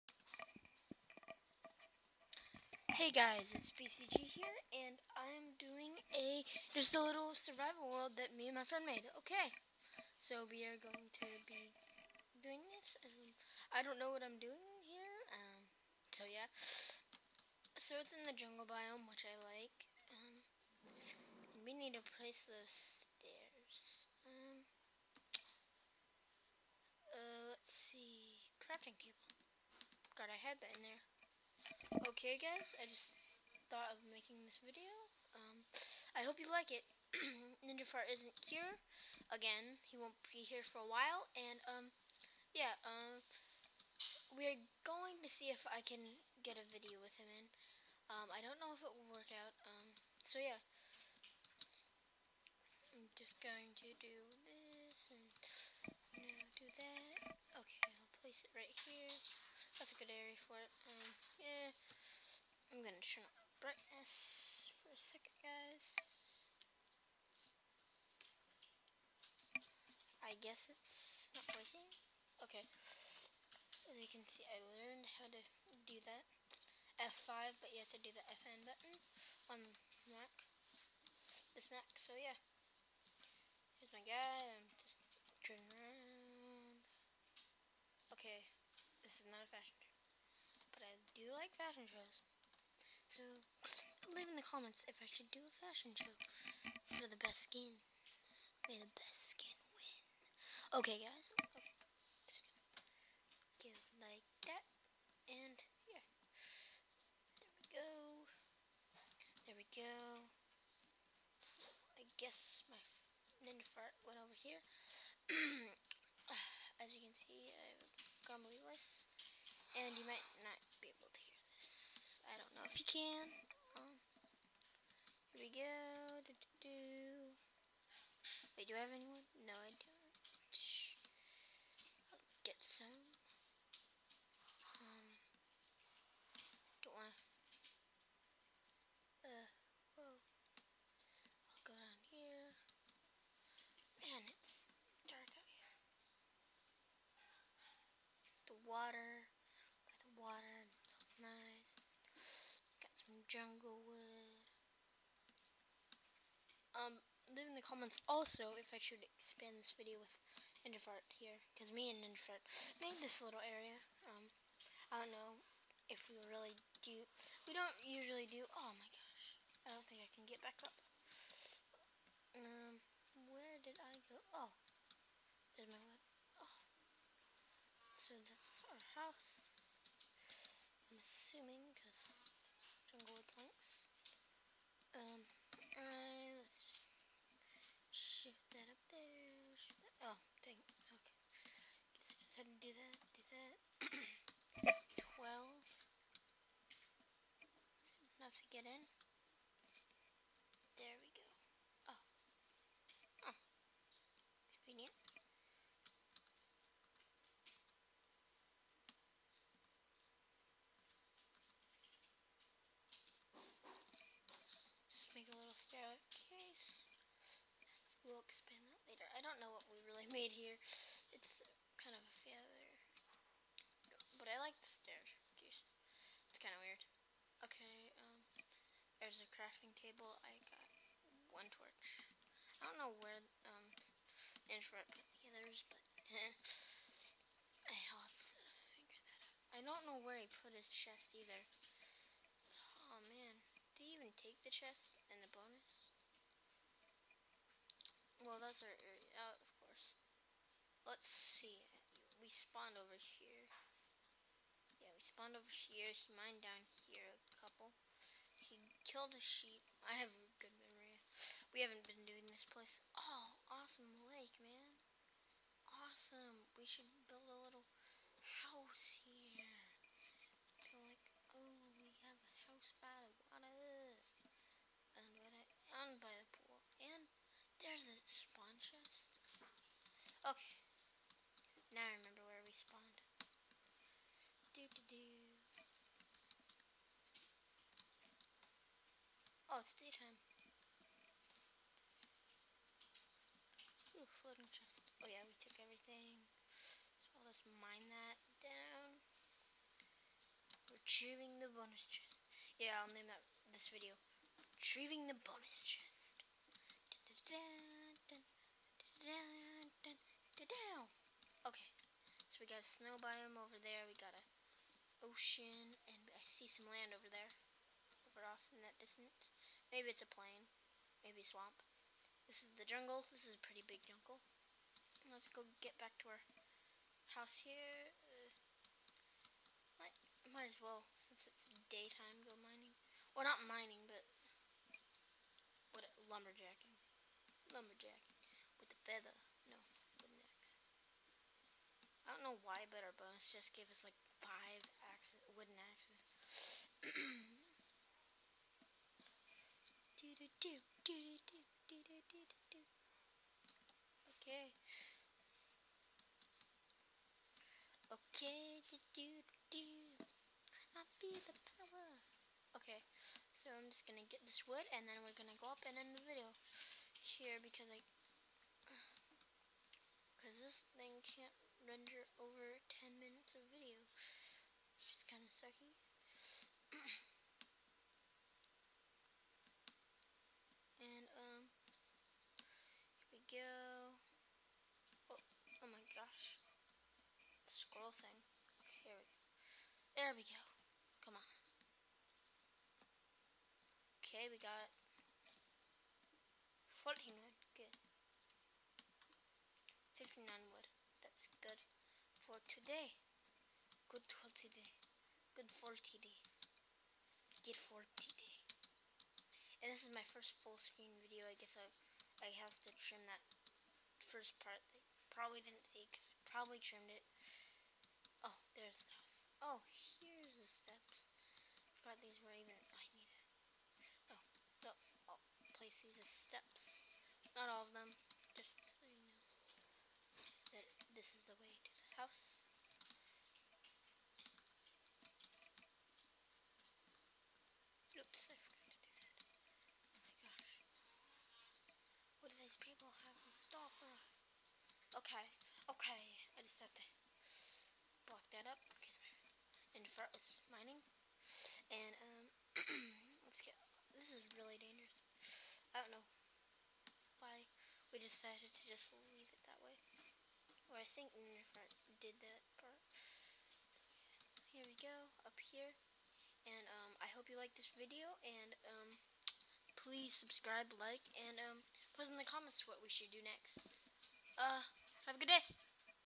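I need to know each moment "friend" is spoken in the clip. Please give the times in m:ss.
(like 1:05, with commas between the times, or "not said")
0:08.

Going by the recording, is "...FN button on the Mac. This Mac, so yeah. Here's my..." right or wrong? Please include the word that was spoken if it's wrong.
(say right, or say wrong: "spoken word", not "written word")
right.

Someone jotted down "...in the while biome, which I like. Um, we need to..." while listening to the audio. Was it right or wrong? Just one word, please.
wrong.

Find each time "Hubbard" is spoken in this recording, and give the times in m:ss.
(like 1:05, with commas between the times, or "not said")
not said.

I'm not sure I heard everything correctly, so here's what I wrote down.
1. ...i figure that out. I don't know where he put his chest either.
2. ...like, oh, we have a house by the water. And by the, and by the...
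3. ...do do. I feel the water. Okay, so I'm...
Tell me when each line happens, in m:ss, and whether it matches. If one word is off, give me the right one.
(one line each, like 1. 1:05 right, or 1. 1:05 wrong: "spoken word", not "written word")
1. 3:55 right
2. 4:30 right
3. 5:58 wrong: "power", not "water".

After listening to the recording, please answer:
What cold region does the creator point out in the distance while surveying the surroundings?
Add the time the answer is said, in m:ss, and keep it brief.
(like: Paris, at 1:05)
snow biome, at 5:12.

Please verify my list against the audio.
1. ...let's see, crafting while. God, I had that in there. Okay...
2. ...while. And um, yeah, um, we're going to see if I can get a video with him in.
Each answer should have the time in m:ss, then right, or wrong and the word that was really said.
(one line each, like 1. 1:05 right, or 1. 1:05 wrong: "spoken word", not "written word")
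1. 0:27 wrong: "table", not "while"
2. 0:40 right.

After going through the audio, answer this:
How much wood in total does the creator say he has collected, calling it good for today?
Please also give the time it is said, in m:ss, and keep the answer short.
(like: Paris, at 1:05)
59, at 6:40.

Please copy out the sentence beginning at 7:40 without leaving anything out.
Or I think Internet did that part.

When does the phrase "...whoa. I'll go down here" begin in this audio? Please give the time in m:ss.
2:19.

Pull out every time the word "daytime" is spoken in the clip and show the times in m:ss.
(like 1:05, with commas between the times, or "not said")
4:49, 5:31.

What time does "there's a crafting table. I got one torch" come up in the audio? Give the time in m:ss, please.
3:49.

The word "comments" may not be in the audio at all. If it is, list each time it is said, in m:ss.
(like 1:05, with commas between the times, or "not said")
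1:34, 2:37, 7:52.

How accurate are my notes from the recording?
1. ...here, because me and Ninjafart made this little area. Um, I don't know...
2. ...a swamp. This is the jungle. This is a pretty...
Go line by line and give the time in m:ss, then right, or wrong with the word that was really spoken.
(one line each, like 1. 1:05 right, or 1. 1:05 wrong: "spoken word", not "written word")
1. 2:41 right
2. 5:21 right.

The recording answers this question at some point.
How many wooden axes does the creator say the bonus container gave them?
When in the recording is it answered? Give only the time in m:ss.
5:44.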